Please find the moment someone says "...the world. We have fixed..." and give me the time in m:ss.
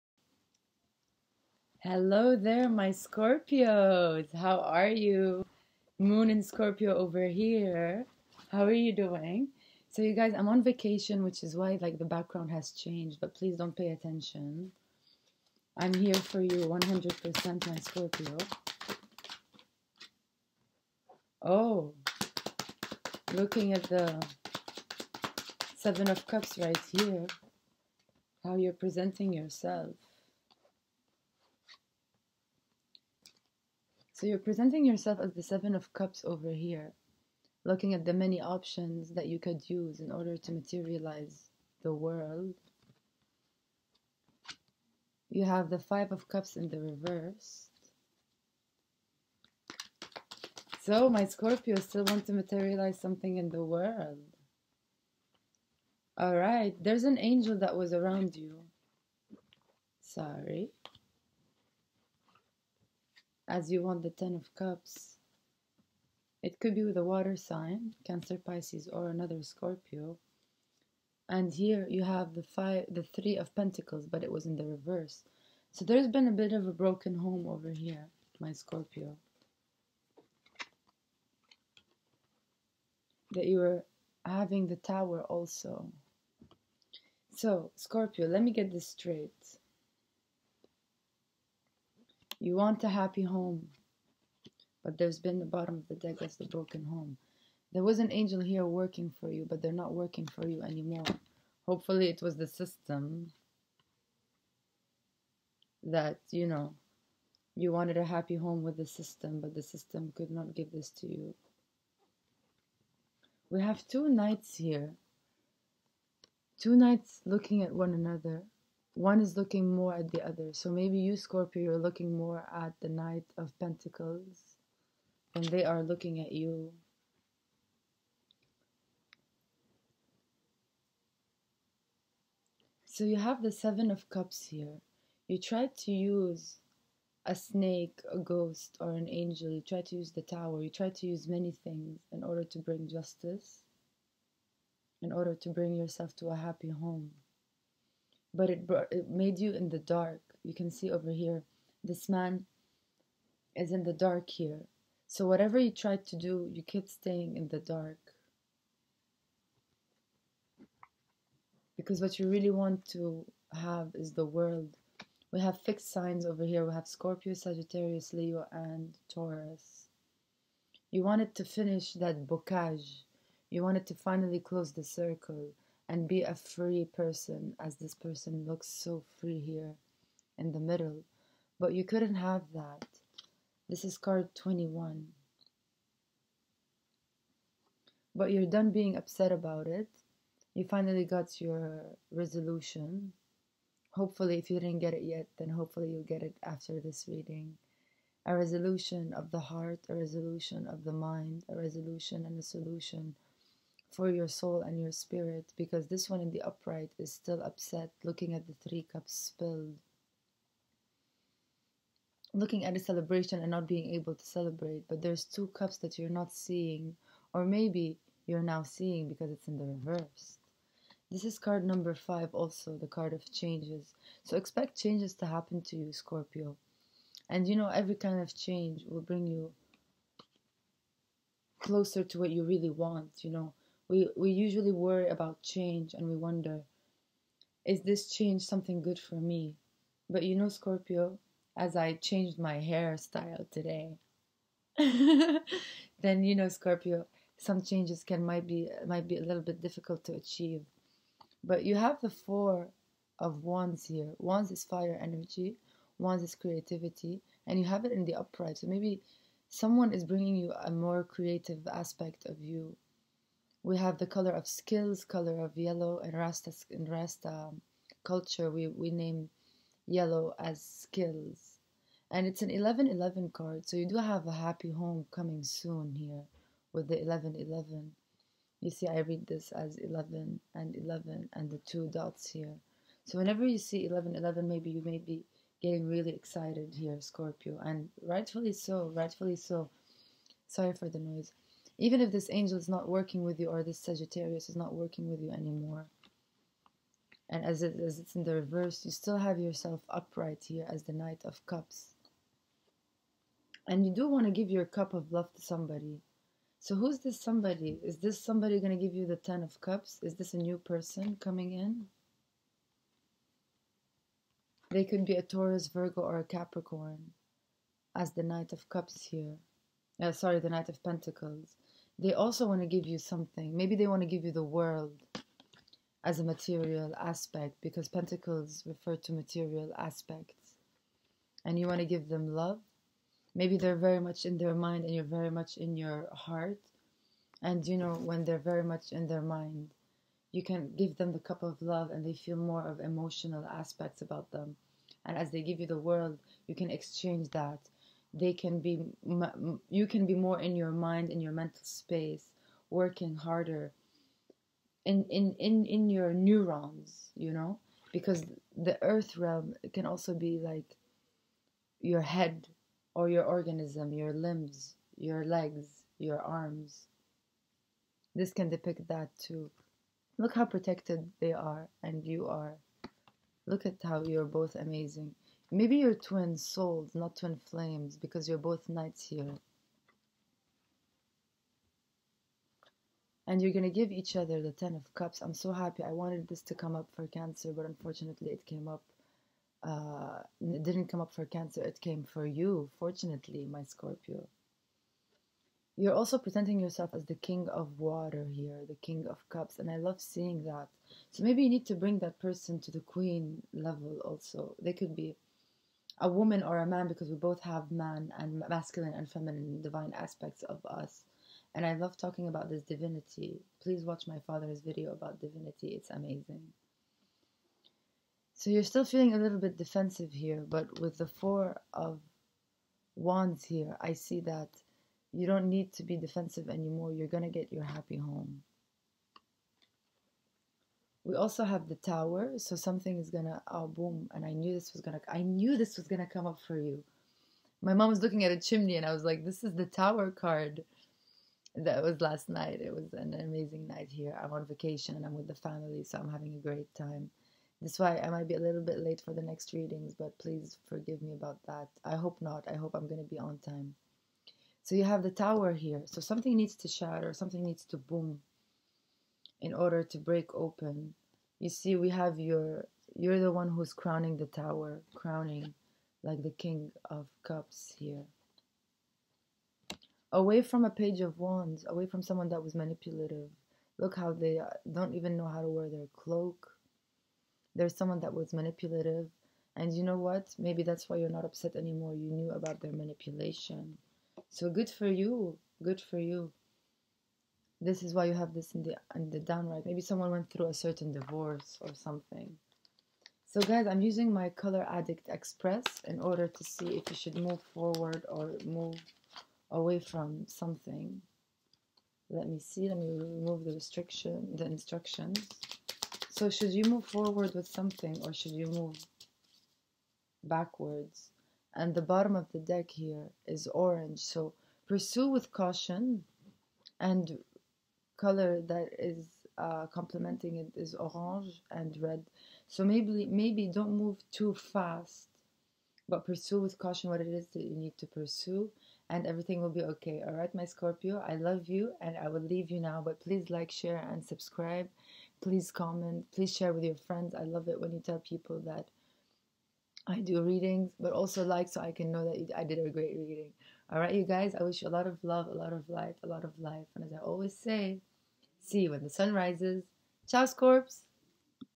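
2:44.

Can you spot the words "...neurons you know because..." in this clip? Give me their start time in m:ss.
5:56.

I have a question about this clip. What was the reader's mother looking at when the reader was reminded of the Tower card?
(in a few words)
a chimney.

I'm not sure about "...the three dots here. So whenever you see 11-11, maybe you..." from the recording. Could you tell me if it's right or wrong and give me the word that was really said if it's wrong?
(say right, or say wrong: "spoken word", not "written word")
wrong: "two", not "three".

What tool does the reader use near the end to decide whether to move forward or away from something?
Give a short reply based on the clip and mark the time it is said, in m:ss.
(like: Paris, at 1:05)
Color Addict Express, at 8:14.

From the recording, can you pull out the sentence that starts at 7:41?
You see, we have your, you're the one who's crowning the tower, crowning like the King of Cups here.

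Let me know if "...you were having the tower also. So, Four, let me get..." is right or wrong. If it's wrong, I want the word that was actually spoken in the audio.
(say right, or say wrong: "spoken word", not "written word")
wrong: "Scorpio", not "Four".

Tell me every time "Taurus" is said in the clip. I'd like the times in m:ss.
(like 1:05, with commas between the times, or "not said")
2:49, 5:15.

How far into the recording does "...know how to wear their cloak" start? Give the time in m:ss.
7:55.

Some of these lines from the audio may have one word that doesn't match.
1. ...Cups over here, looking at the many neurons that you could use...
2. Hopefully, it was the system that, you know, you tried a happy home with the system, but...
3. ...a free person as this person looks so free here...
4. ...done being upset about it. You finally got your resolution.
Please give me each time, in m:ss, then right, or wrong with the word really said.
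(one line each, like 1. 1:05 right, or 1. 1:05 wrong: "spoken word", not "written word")
1. 0:35 wrong: "options", not "neurons"
2. 1:41 wrong: "wanted", not "tried"
3. 2:56 right
4. 3:08 right.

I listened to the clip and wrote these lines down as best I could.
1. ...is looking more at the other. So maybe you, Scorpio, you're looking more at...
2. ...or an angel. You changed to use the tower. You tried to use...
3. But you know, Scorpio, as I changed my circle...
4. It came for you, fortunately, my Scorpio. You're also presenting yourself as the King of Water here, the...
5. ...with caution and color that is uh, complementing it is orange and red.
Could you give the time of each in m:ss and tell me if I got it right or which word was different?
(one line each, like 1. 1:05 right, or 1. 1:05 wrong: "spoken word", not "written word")
1. 1:59 right
2. 2:18 wrong: "tried", not "changed"
3. 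4:00 wrong: "hairstyle", not "circle"
4. 6:31 right
5. 8:35 right.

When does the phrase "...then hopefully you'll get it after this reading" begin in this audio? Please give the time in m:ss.
3:15.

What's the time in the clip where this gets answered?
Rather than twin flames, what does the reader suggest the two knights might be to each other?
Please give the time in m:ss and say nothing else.
6:15.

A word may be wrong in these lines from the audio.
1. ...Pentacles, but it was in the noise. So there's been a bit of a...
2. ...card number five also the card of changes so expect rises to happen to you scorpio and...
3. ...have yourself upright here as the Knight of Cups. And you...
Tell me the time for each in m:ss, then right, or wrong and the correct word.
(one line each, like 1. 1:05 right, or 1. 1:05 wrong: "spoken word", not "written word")
1. 1:13 wrong: "reverse", not "noise"
2. 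3:41 wrong: "changes", not "rises"
3. 4:59 right.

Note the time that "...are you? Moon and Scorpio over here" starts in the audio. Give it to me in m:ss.
0:04.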